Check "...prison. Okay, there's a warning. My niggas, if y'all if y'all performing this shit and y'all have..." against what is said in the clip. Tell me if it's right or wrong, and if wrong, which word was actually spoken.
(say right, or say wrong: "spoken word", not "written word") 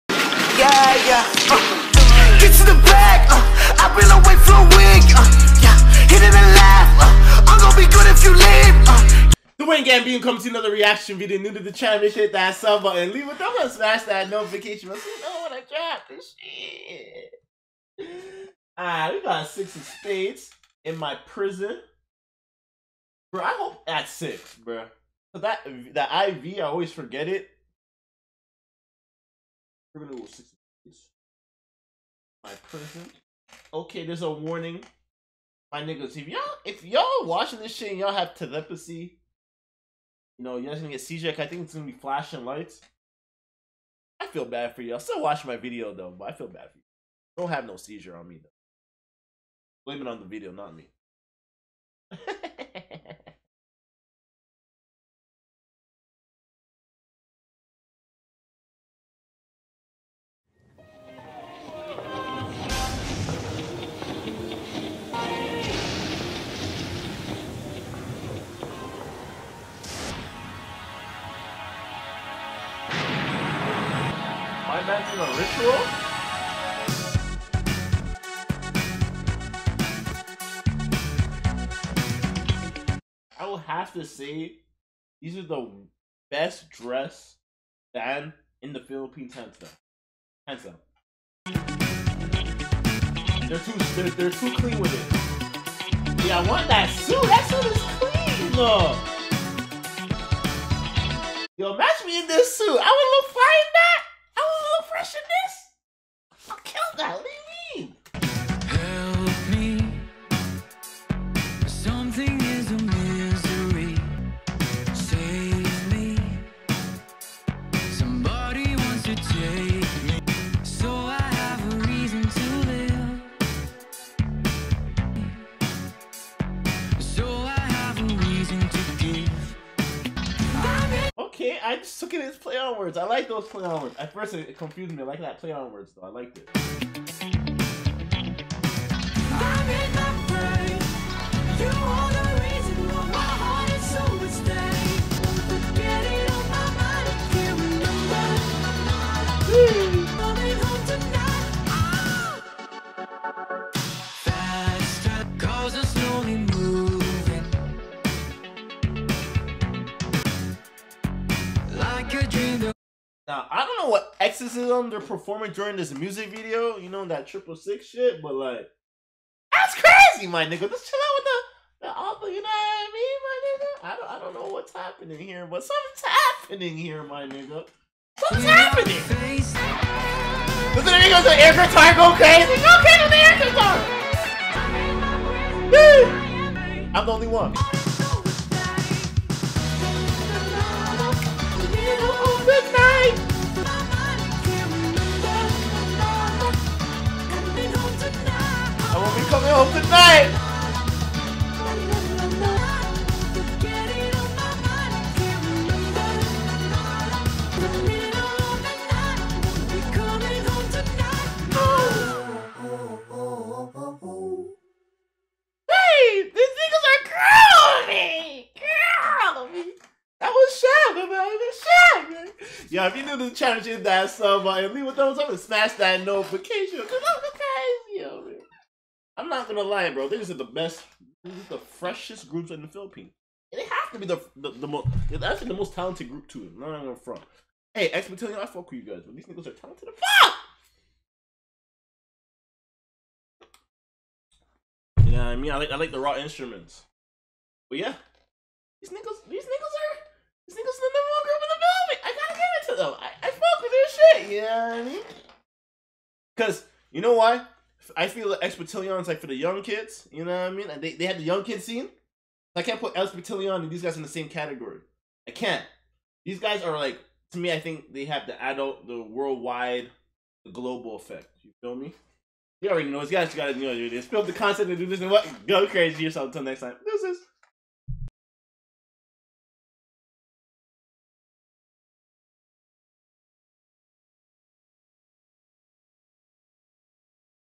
wrong: "watching", not "performing".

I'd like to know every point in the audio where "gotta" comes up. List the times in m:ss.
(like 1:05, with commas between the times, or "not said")
4:12.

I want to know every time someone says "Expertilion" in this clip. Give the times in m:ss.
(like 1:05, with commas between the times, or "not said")
4:22.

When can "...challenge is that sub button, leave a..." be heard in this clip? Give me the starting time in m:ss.
3:43.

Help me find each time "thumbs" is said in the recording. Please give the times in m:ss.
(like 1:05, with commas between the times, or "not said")
0:13, 3:44.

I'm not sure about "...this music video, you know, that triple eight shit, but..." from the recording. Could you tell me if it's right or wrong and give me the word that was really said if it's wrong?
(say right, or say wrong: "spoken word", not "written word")
wrong: "six", not "eight".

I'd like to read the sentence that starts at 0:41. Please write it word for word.
I think it's gonna be flashing lights.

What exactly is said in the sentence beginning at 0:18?
Alright, we got six of spades in my prison.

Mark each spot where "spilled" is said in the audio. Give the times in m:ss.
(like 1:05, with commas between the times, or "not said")
4:34.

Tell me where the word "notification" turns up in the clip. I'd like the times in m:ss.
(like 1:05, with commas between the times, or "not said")
0:14, 3:46.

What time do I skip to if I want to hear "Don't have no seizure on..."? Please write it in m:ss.
0:47.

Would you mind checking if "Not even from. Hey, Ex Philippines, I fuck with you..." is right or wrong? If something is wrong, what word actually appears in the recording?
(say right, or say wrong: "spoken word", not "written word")
wrong: "Battalion", not "Philippines".